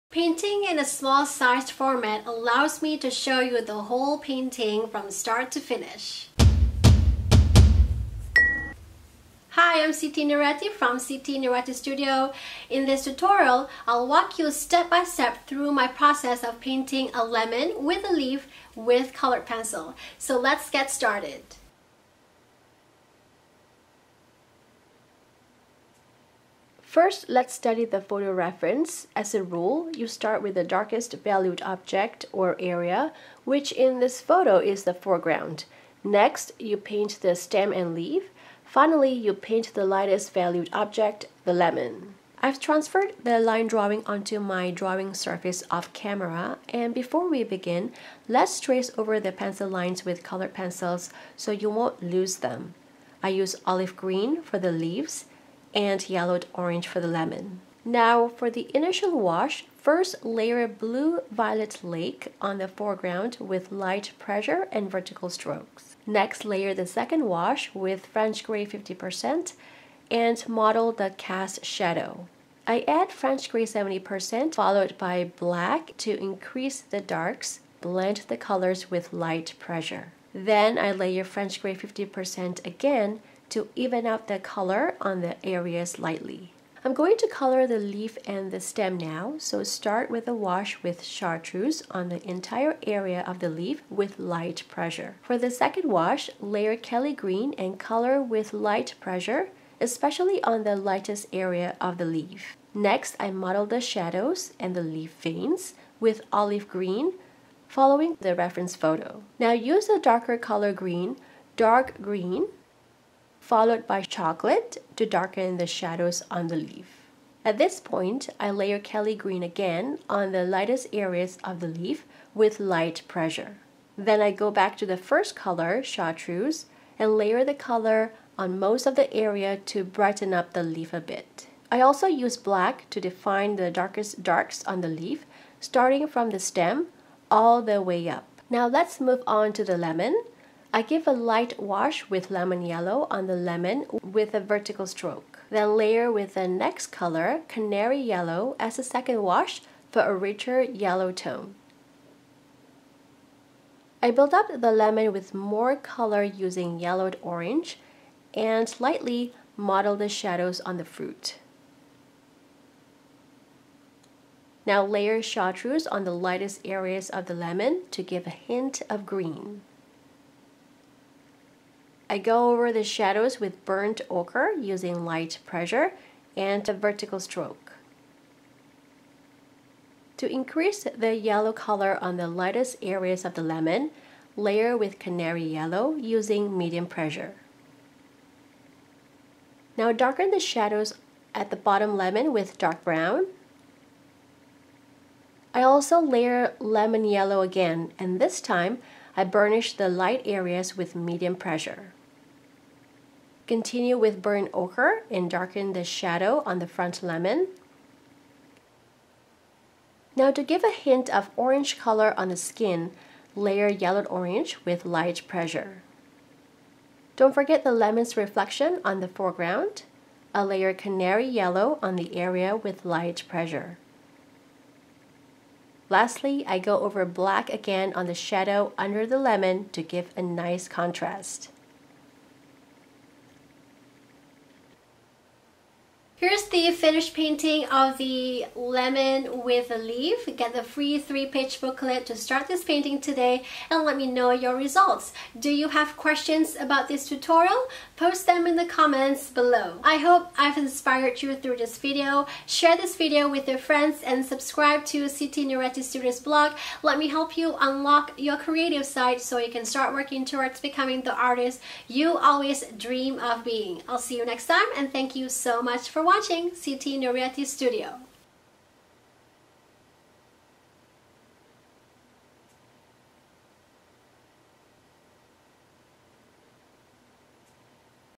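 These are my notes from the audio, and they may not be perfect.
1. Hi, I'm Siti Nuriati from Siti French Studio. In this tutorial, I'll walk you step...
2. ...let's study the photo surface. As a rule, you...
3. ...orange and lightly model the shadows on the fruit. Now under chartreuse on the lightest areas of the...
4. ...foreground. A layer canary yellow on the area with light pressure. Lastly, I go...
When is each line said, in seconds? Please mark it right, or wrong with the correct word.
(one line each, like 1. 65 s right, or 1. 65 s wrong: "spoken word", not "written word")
1. 9 s wrong: "Nuriati", not "French"
2. 27 s wrong: "reference", not "surface"
3. 157 s wrong: "layer", not "under"
4. 219 s right.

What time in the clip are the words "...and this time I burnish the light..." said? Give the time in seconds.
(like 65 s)
197 s.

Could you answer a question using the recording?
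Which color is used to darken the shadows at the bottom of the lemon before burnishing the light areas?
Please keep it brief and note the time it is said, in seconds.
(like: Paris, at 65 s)
Dark brown, at 192 s.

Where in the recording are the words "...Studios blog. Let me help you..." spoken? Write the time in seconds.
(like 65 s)
255 s.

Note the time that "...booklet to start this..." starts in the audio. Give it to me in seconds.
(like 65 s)
241 s.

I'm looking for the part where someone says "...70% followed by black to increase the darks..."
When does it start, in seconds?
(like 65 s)
73 s.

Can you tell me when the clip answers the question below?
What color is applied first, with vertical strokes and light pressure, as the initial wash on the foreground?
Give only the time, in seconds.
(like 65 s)
60 s.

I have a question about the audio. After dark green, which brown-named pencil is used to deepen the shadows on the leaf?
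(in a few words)
Chocolate.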